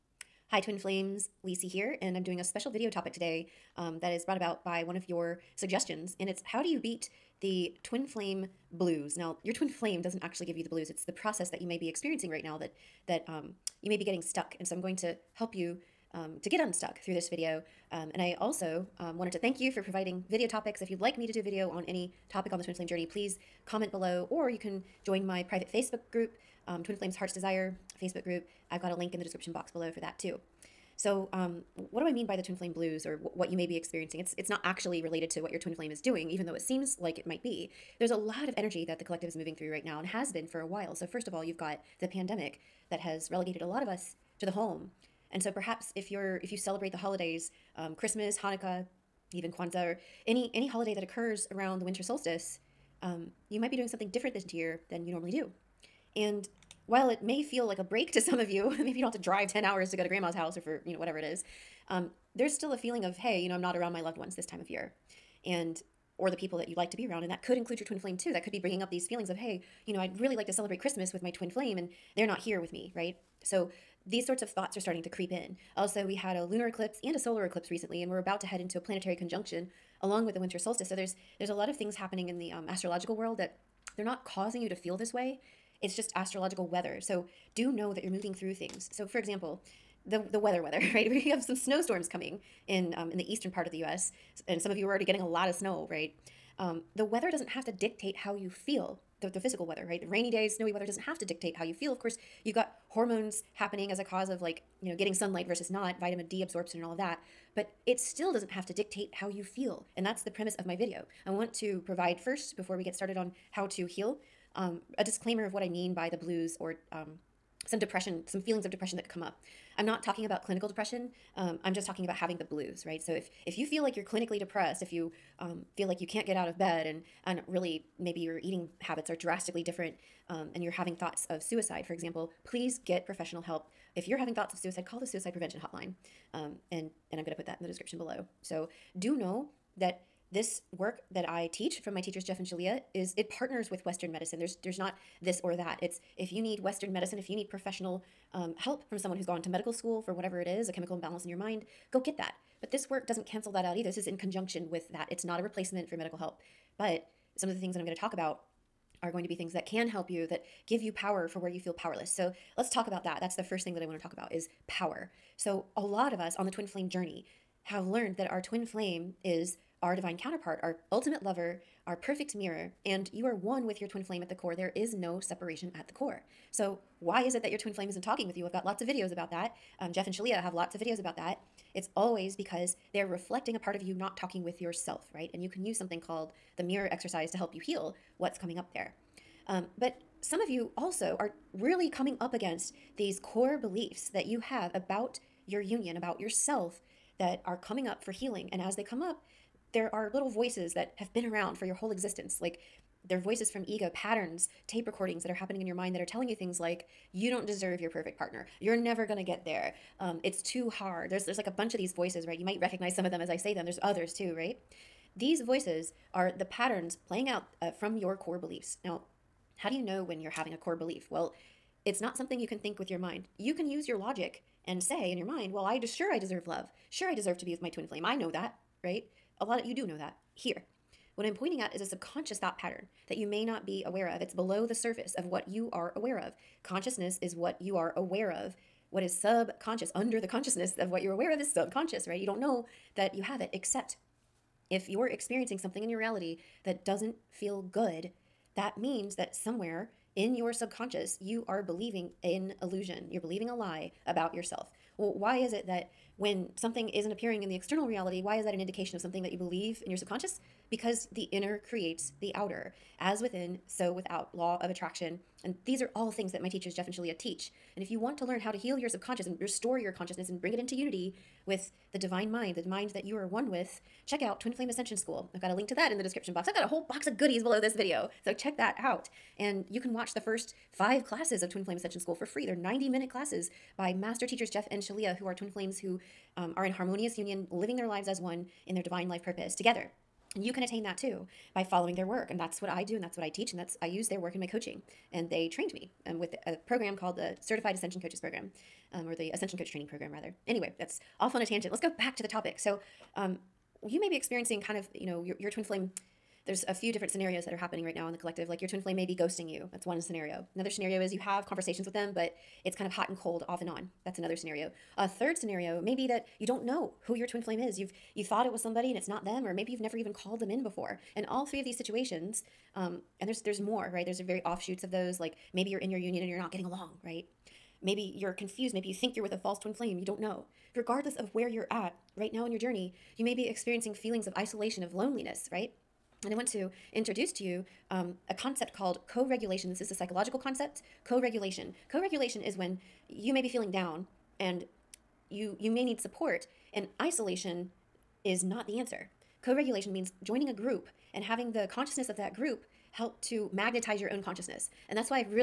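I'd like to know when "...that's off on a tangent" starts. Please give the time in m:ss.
5:00.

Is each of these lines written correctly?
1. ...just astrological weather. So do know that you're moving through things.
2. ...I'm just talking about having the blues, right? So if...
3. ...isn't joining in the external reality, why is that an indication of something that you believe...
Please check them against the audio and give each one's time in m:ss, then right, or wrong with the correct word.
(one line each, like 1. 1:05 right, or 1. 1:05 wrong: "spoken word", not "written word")
1. 1:25 right
2. 2:01 right
3. 4:16 wrong: "appearing", not "joining".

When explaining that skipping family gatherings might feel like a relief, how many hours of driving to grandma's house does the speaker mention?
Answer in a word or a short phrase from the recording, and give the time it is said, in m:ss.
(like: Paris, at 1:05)
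10, at 0:59.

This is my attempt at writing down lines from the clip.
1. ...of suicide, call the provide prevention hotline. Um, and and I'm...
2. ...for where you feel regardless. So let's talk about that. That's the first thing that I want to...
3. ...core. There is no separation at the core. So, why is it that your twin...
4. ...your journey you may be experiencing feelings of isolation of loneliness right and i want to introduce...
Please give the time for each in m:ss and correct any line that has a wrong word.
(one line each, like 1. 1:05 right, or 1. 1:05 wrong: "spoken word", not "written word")
1. 2:14 wrong: "suicide", not "provide"
2. 2:41 wrong: "powerless", not "regardless"
3. 2:54 right
4. 5:32 right.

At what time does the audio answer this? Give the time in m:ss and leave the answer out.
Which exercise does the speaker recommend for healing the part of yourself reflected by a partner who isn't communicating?
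3:06.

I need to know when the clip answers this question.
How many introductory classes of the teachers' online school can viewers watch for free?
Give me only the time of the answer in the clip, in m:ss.
4:40.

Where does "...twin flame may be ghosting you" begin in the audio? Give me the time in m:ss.
5:08.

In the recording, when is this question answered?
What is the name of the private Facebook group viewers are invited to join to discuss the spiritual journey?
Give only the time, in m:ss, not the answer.
0:26.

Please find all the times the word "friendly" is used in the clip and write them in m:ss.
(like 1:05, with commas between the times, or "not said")
not said.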